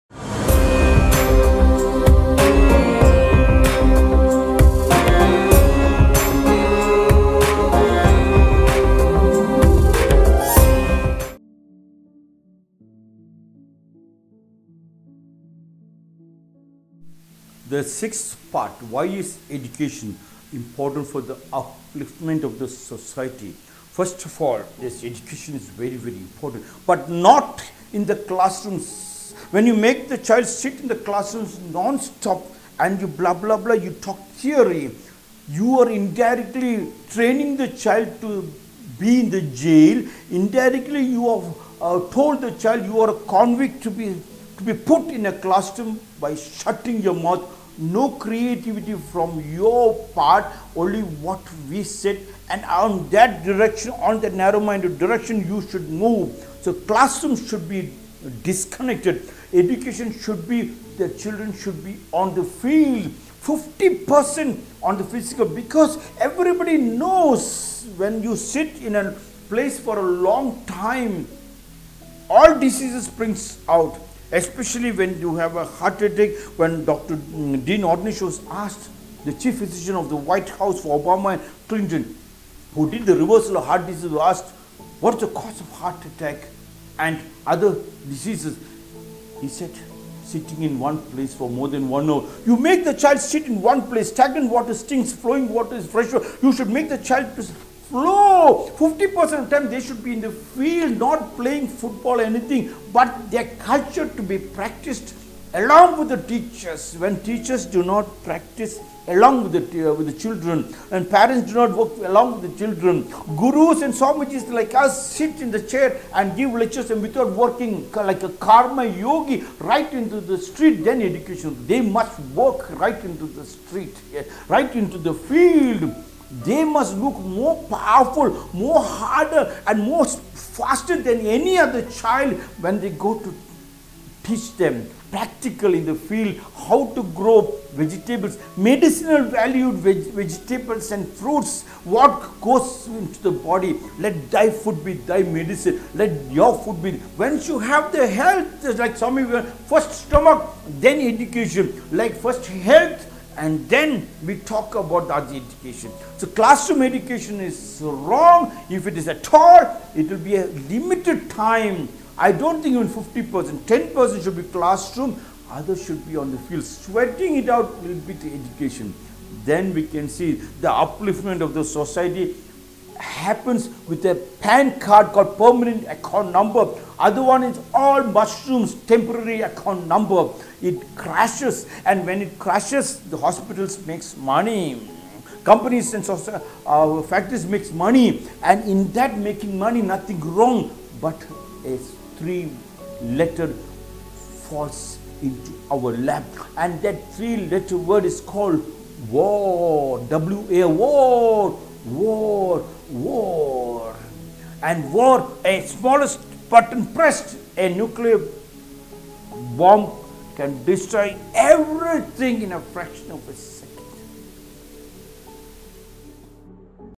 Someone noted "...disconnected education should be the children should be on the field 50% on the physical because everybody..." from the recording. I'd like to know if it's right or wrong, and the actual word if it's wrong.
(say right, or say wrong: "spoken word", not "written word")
right.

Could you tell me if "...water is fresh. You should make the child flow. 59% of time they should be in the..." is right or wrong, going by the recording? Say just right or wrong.
wrong.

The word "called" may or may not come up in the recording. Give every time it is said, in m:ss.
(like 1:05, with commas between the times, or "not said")
2:55, 3:18.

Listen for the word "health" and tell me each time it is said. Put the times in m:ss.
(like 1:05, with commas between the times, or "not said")
2:28, 2:32.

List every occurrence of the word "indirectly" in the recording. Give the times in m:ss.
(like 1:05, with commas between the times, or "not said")
0:35, 0:40.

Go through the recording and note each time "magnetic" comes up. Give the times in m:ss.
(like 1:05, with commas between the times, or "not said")
not said.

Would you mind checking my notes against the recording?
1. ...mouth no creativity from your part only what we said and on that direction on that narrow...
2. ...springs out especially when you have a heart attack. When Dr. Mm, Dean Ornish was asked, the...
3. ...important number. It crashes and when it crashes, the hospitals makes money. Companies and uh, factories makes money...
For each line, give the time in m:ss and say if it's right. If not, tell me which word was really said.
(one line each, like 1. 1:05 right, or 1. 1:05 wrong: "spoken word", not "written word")
1. 0:47 right
2. 1:13 right
3. 2:59 wrong: "account", not "important".